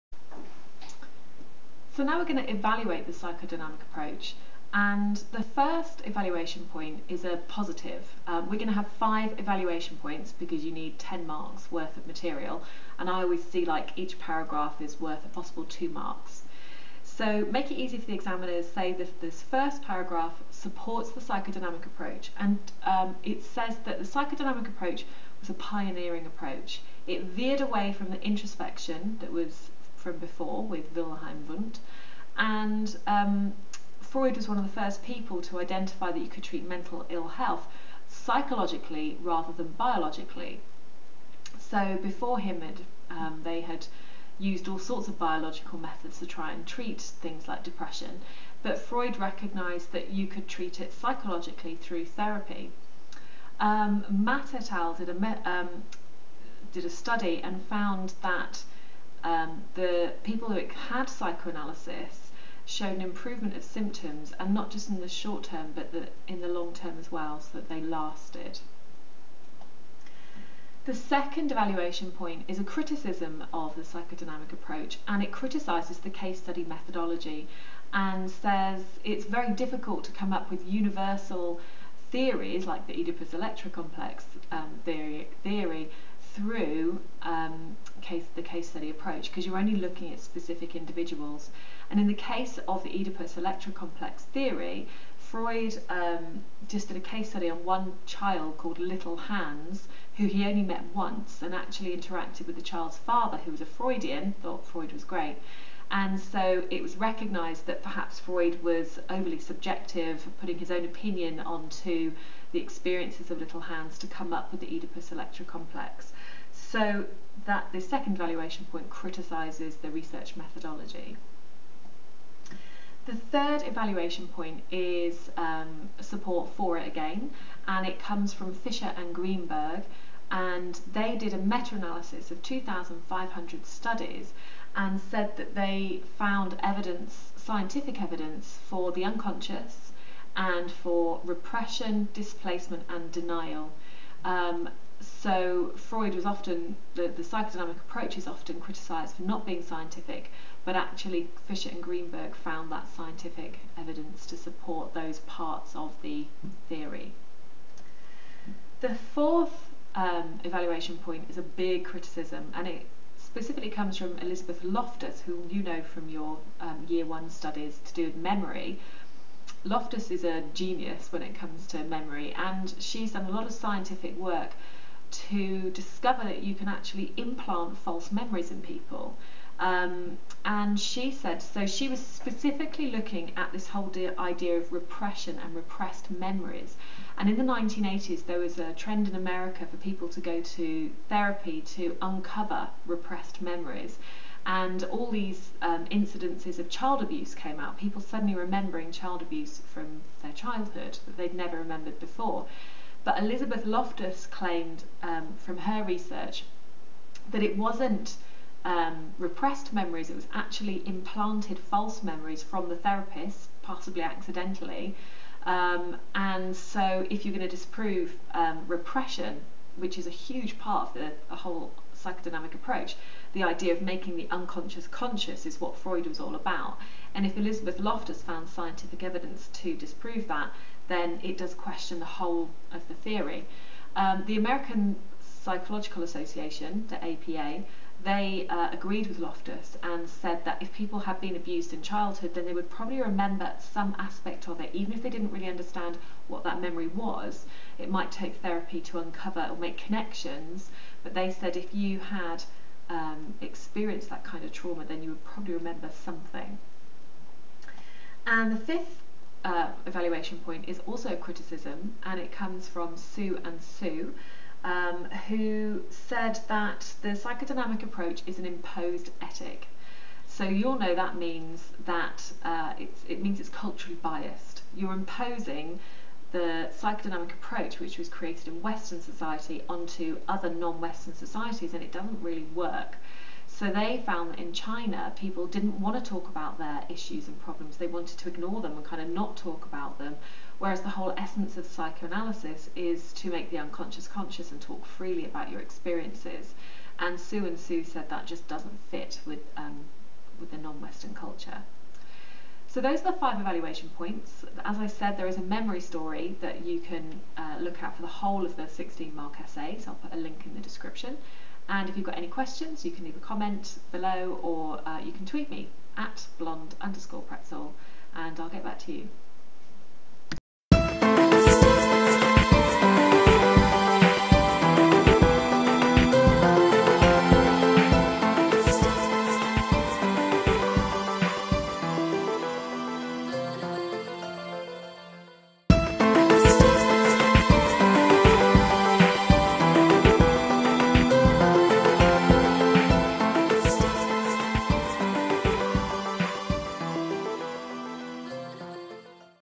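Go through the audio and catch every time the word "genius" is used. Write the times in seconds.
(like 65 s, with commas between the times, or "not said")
170 s.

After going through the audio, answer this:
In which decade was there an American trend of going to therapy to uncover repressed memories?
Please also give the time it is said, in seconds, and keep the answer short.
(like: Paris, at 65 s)
1980s, at 187 s.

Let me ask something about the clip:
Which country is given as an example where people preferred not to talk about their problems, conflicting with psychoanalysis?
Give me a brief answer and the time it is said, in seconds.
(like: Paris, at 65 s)
China, at 284 s.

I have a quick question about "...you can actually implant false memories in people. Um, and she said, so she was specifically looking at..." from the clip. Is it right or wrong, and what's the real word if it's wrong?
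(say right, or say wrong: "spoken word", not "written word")
right.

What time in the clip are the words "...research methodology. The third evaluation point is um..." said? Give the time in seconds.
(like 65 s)
119 s.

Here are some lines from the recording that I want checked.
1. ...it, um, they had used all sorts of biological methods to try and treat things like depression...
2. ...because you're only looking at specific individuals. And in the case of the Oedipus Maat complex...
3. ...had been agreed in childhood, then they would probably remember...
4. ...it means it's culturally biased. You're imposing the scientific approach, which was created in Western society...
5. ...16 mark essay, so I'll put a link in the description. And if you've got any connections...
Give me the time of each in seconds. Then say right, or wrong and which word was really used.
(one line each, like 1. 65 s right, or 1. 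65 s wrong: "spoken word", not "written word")
1. 42 s right
2. 89 s wrong: "Electra", not "Maat"
3. 240 s wrong: "abused", not "agreed"
4. 273 s wrong: "psychodynamic", not "scientific"
5. 308 s wrong: "questions", not "connections".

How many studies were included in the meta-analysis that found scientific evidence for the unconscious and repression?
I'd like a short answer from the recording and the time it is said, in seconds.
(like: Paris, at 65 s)
2,500, at 132 s.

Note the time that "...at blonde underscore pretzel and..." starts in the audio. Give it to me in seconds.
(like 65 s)
315 s.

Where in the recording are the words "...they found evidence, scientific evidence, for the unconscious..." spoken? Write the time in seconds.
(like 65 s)
135 s.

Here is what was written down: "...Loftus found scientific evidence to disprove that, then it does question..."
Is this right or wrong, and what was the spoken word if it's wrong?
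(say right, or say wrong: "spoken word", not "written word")
right.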